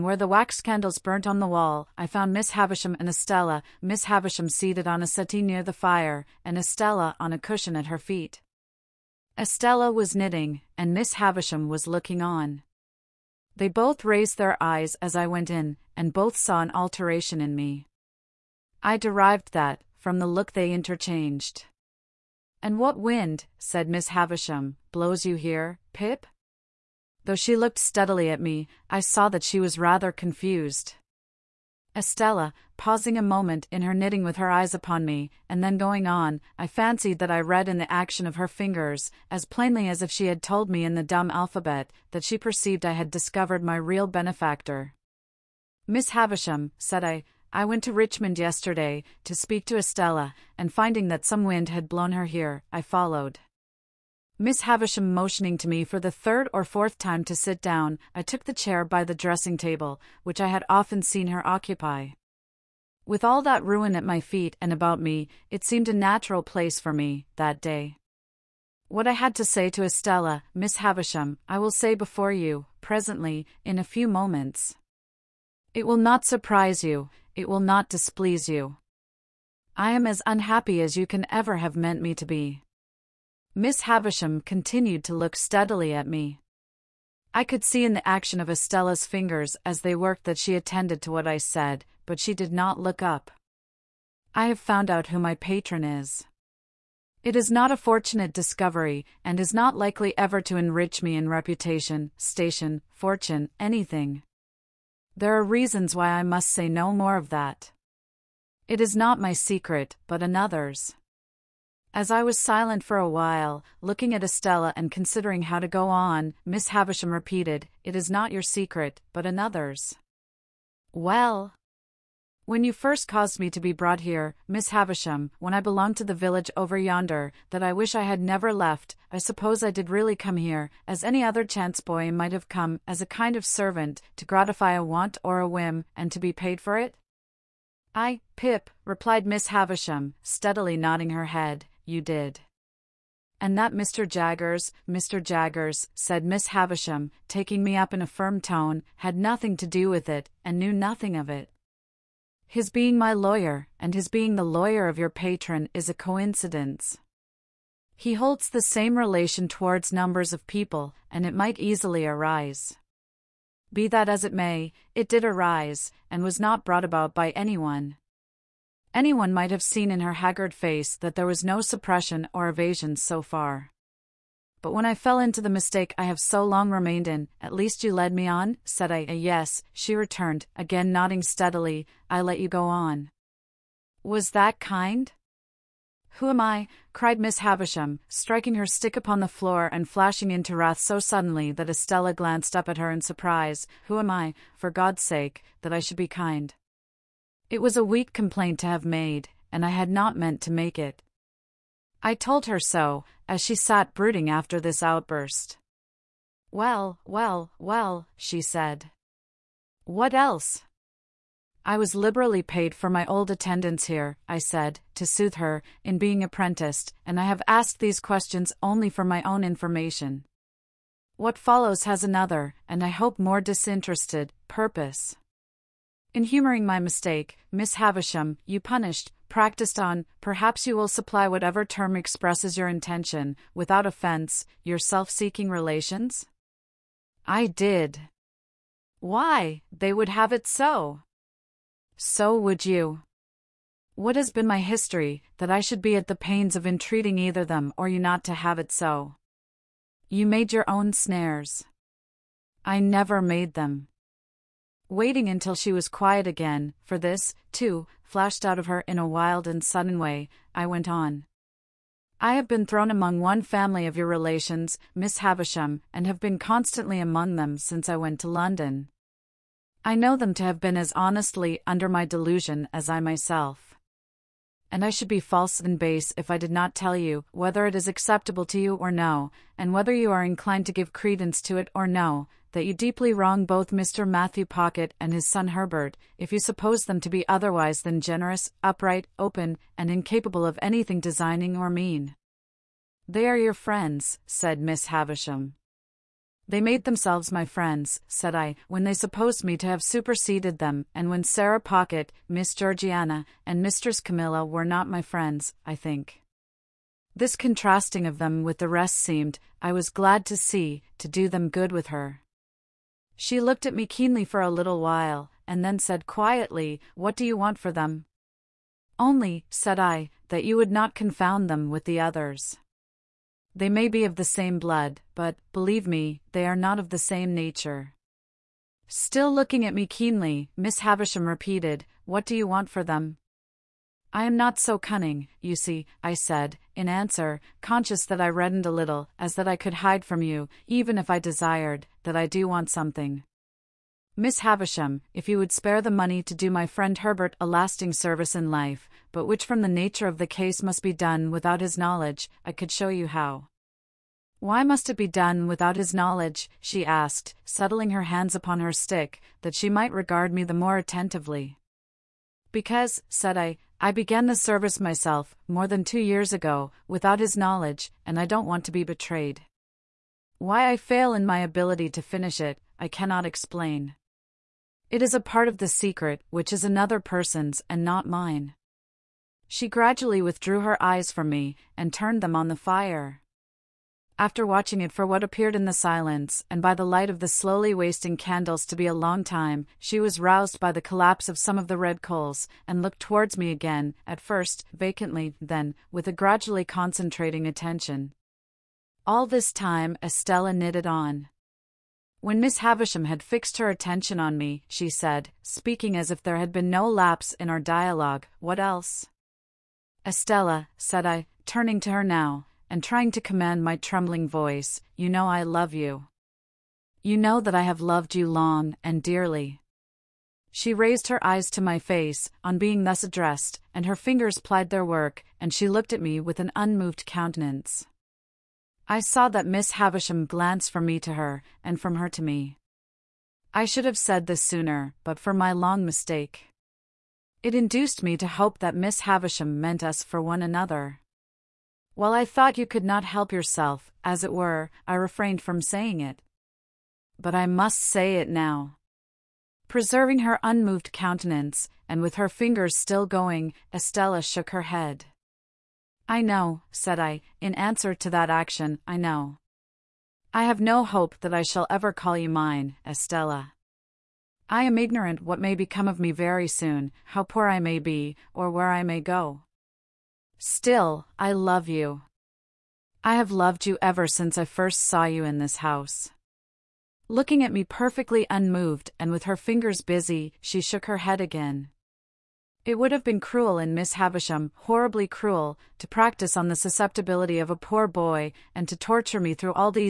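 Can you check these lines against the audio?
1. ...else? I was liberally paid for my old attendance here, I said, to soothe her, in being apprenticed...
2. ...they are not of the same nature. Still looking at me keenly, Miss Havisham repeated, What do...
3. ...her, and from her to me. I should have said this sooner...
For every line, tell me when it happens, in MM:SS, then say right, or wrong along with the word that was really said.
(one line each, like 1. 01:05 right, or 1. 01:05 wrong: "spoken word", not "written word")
1. 03:30 right
2. 05:26 right
3. 07:11 right.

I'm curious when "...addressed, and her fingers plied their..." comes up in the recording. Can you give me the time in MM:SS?
07:03.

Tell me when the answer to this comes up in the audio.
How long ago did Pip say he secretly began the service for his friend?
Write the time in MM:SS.
06:05.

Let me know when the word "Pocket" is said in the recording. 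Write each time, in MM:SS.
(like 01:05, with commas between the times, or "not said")
04:44, 05:01.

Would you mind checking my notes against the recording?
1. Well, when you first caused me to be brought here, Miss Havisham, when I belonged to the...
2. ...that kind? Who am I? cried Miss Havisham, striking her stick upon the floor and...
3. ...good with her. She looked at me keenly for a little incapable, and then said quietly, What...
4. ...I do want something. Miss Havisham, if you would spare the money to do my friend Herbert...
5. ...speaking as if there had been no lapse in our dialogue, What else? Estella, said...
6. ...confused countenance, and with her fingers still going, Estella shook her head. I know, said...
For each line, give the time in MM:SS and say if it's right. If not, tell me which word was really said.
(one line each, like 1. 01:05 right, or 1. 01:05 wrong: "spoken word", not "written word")
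1. 02:00 right
2. 03:04 right
3. 05:11 wrong: "while", not "incapable"
4. 05:42 right
5. 06:45 right
6. 07:30 wrong: "unmoved", not "confused".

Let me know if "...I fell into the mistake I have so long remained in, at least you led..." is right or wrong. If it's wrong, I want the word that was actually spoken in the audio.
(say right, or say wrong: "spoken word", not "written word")
right.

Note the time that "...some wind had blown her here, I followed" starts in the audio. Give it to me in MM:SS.
00:51.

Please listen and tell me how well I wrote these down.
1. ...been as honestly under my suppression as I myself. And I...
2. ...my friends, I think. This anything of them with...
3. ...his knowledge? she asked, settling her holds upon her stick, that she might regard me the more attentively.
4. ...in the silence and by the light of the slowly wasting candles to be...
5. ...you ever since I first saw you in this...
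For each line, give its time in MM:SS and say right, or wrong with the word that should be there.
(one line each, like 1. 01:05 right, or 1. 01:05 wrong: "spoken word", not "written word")
1. 04:30 wrong: "delusion", not "suppression"
2. 05:04 wrong: "contrasting", not "anything"
3. 05:55 wrong: "hands", not "holds"
4. 06:25 right
5. 07:53 right.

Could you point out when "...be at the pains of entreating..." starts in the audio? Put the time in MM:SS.
04:05.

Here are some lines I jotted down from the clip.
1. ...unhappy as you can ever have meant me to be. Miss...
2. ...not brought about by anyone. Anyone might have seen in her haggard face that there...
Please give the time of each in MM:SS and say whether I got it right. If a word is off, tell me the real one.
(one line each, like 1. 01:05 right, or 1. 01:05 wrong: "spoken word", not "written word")
1. 01:20 right
2. 02:46 right.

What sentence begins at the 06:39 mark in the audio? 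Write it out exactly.
All this time, Estella knitted on.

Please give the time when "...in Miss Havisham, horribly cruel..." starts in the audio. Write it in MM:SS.
08:03.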